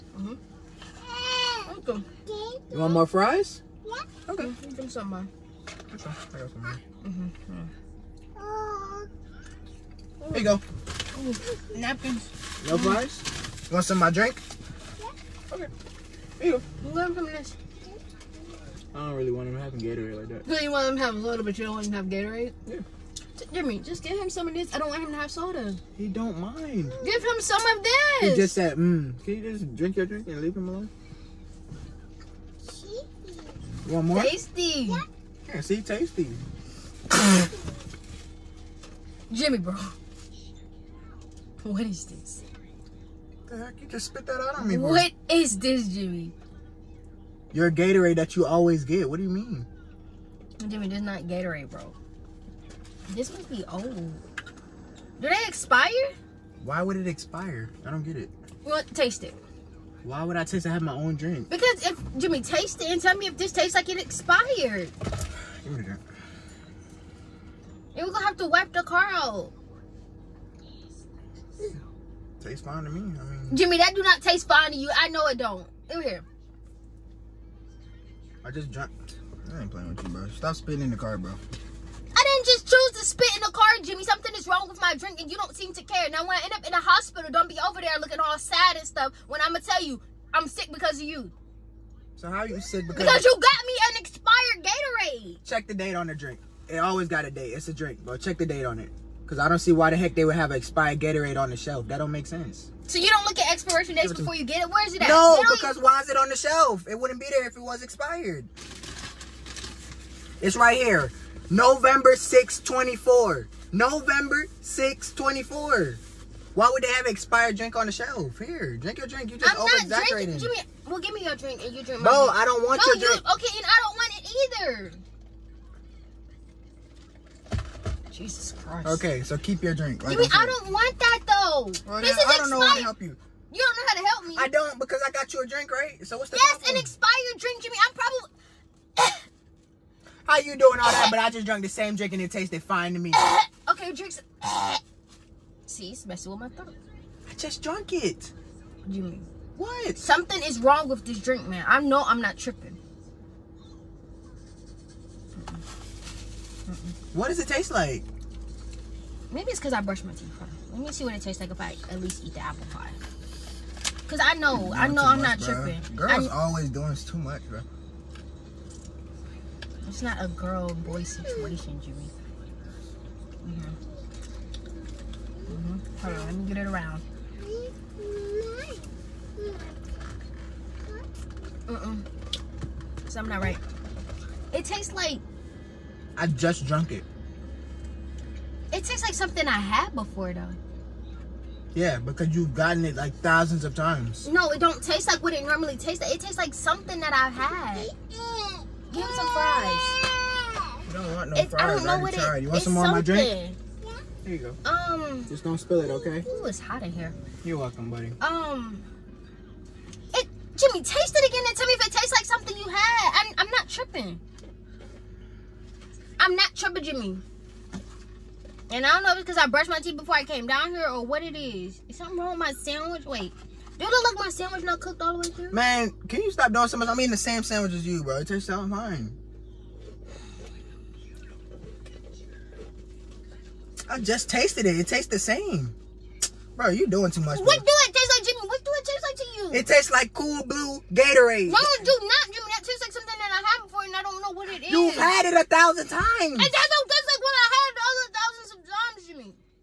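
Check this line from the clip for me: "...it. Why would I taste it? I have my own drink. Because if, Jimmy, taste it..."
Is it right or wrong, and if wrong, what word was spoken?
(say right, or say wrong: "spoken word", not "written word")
right.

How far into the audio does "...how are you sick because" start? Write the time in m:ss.
1:32.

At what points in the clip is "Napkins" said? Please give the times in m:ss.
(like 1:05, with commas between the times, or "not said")
0:11.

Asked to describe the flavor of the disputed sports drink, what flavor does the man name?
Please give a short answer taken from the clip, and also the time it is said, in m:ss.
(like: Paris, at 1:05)
cool blue, at 4:00.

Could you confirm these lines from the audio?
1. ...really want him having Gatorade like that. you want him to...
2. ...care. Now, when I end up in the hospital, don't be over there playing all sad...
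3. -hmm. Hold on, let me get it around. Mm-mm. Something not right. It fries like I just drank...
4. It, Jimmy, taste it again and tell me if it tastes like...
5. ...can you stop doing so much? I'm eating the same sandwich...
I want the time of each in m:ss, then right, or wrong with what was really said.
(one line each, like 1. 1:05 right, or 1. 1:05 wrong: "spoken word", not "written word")
1. 0:19 right
2. 1:25 wrong: "looking", not "playing"
3. 2:55 wrong: "tastes", not "fries"
4. 3:30 right
5. 3:46 right.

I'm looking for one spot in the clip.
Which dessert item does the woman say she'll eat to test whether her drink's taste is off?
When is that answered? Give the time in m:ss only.
2:42.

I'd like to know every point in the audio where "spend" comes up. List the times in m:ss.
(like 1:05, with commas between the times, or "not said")
not said.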